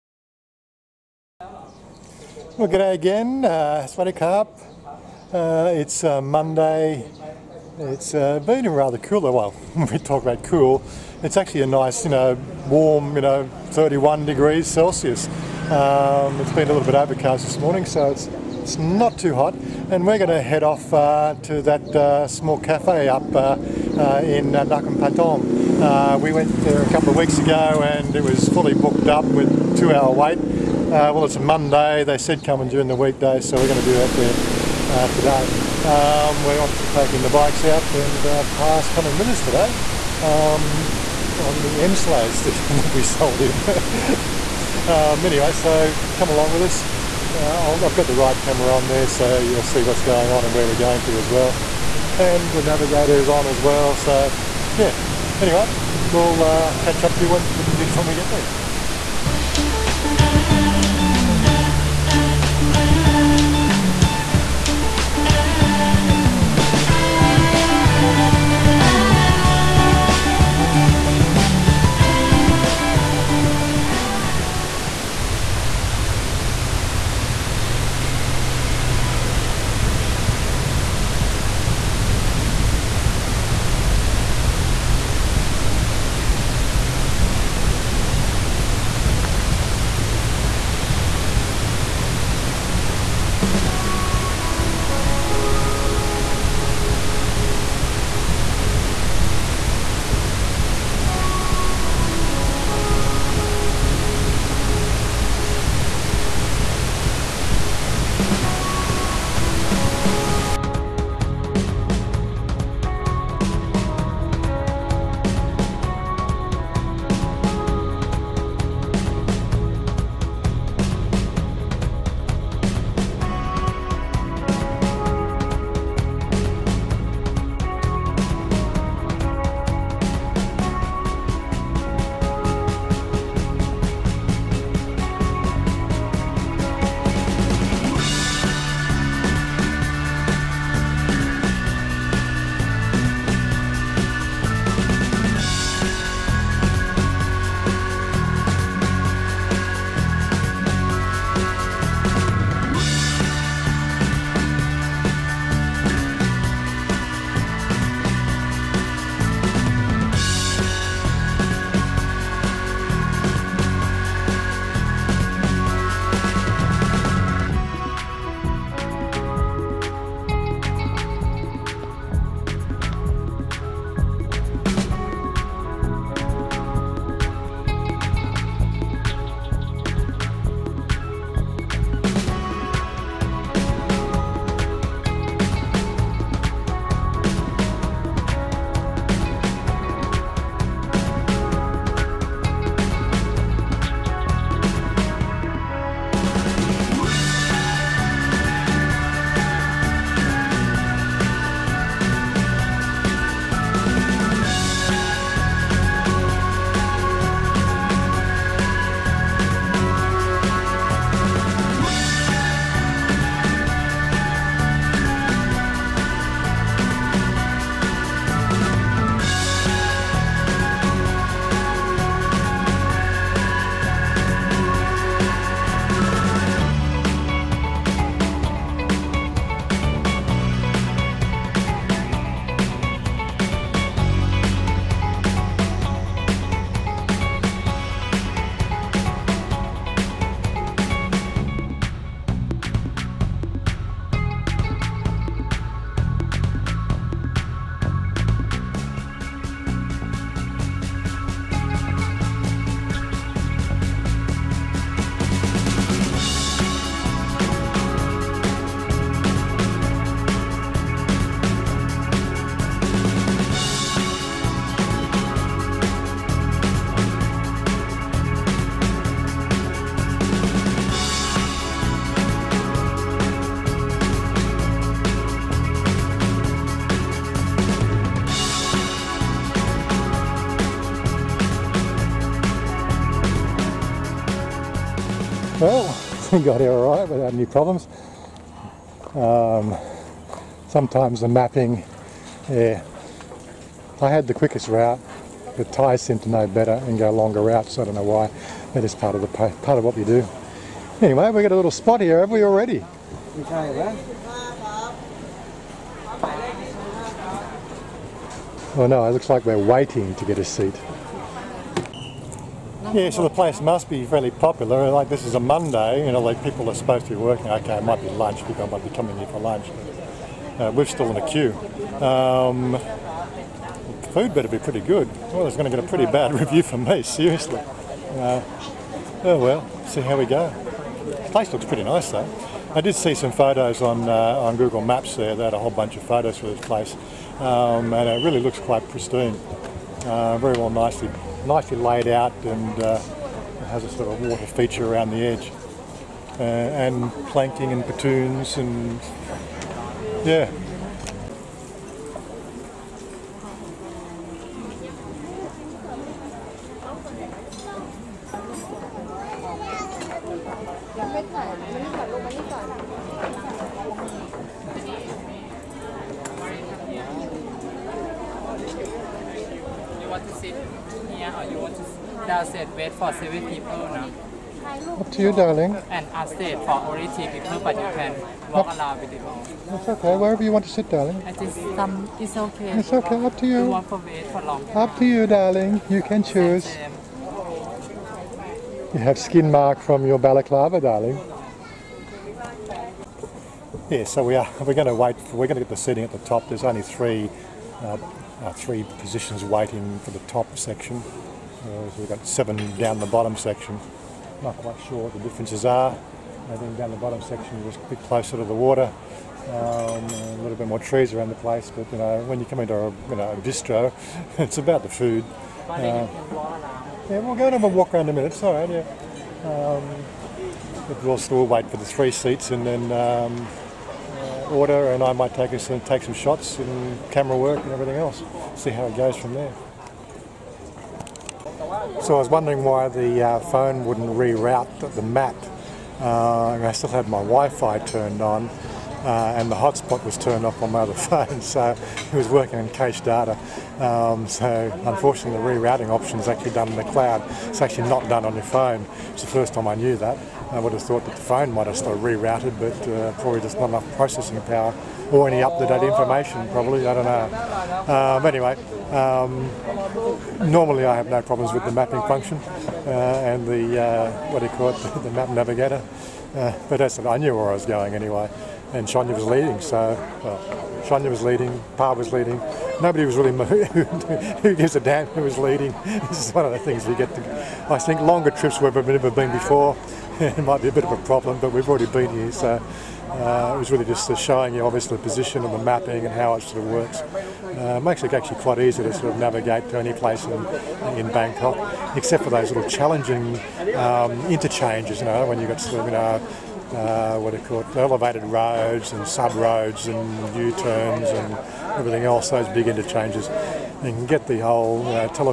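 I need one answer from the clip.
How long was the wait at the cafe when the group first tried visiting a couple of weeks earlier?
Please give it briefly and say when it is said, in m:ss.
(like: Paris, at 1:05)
two-hour wait, at 0:29.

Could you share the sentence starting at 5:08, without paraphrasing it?
Oh no, it looks like we're waiting to get a seat.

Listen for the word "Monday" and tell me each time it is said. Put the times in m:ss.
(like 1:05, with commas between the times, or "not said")
0:06, 0:31, 5:15.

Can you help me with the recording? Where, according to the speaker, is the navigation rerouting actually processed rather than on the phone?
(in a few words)
in the cloud.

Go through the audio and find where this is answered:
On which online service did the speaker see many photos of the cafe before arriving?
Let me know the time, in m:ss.
5:34.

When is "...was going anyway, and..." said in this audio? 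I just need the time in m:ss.
7:47.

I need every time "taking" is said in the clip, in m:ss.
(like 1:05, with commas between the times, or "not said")
0:36.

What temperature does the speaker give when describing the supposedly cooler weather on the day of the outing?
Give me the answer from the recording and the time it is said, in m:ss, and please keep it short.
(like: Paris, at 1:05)
31 degrees Celsius, at 0:13.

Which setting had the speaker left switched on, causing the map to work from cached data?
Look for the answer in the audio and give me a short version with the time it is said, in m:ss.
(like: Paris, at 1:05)
Wi-Fi, at 7:17.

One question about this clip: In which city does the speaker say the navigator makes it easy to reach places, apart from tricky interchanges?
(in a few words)
Bangkok.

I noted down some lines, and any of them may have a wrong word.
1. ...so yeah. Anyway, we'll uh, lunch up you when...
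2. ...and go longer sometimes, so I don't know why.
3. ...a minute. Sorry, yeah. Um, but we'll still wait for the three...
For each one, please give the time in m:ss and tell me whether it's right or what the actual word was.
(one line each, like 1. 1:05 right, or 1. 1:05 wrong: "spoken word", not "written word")
1. 0:53 wrong: "catch", not "lunch"
2. 4:56 wrong: "routes", not "sometimes"
3. 6:58 right.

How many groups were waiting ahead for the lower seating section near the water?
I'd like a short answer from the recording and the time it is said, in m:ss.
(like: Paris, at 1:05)
7, at 6:42.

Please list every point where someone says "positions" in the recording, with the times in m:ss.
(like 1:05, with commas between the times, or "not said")
6:38, 8:05.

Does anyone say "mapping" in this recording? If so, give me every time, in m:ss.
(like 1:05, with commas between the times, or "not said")
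4:51, 7:41, 8:05.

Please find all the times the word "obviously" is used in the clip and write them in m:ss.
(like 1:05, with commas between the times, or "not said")
0:36, 8:04.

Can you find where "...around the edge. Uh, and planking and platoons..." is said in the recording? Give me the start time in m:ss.
5:44.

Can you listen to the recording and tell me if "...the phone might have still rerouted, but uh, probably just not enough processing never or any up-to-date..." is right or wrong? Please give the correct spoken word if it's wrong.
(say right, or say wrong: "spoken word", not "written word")
wrong: "power", not "never".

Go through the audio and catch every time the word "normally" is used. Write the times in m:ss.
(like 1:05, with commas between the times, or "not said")
7:40.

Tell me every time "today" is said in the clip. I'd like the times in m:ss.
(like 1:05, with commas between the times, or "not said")
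0:35, 0:39.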